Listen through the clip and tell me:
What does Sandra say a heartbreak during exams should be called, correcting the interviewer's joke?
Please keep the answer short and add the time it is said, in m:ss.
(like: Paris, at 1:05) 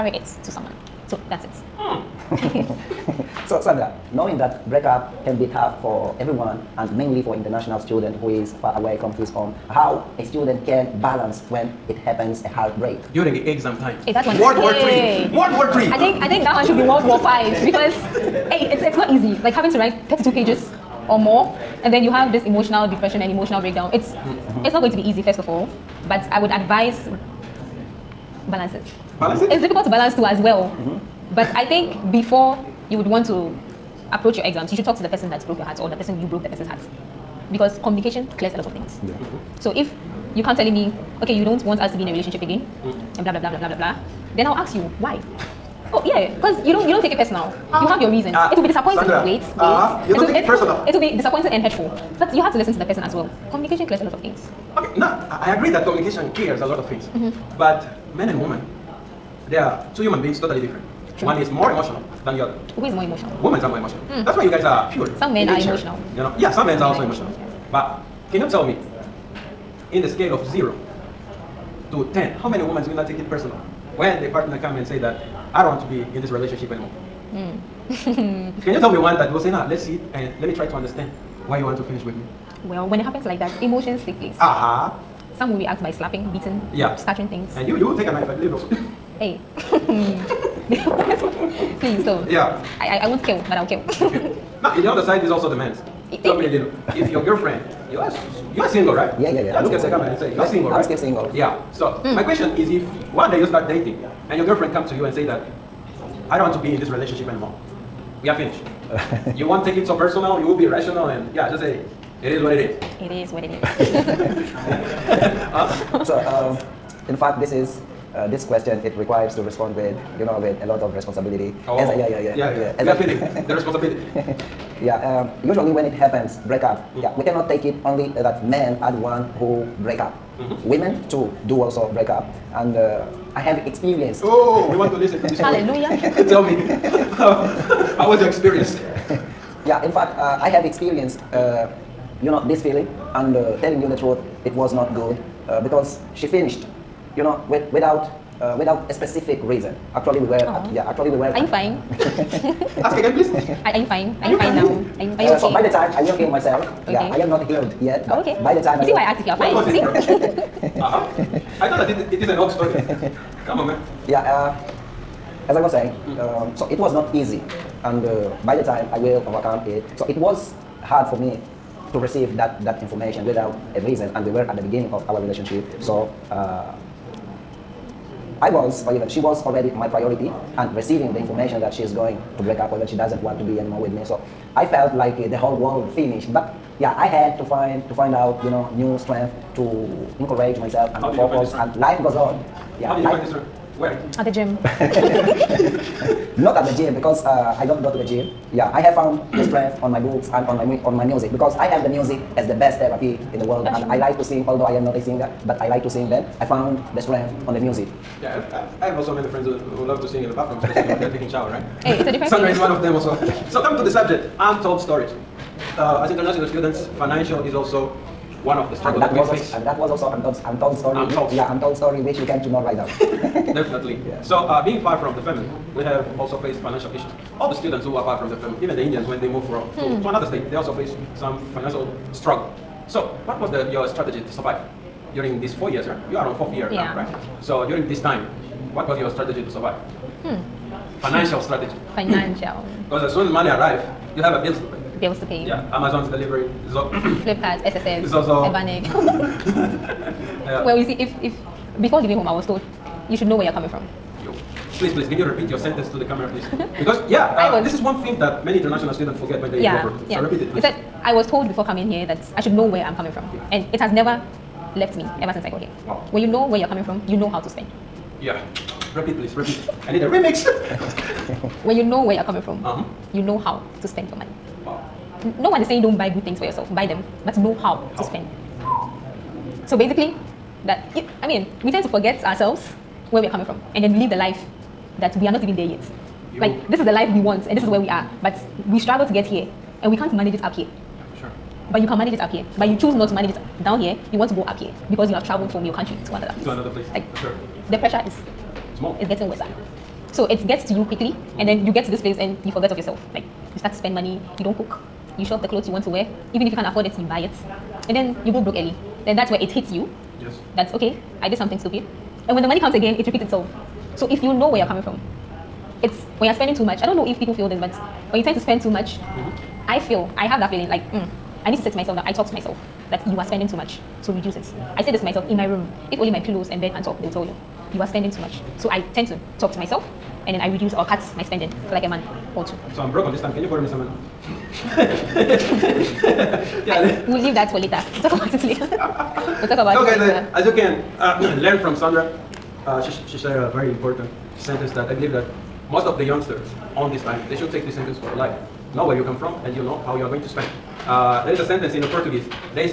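World War Five, at 0:16.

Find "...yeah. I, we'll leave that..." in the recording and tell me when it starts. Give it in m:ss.
5:36.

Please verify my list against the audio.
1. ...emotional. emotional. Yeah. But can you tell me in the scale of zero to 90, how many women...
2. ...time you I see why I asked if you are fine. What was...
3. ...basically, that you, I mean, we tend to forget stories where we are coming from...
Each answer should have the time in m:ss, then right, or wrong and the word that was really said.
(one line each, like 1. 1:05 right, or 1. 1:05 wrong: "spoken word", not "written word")
1. 1:07 wrong: "10", not "90"
2. 2:38 right
3. 4:39 wrong: "ourselves", not "stories".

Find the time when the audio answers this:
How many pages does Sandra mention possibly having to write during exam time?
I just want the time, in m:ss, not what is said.
0:20.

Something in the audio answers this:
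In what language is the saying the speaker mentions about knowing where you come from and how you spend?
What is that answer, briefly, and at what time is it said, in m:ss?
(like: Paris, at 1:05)
Portuguese, at 5:51.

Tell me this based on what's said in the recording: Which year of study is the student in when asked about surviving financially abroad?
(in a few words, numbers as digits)
fourth year.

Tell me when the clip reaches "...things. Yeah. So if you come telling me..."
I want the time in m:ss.
0:38.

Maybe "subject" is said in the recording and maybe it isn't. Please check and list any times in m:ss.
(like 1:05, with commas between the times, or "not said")
3:33.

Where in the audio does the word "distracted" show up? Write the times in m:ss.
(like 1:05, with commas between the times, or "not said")
not said.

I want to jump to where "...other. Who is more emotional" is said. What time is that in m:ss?
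1:02.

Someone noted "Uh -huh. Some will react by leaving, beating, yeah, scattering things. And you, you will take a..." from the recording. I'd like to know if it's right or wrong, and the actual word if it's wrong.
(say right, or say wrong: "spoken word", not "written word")
wrong: "slapping", not "leaving".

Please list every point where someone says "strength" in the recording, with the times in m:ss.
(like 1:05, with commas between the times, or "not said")
3:08, 3:13, 3:19, 3:26.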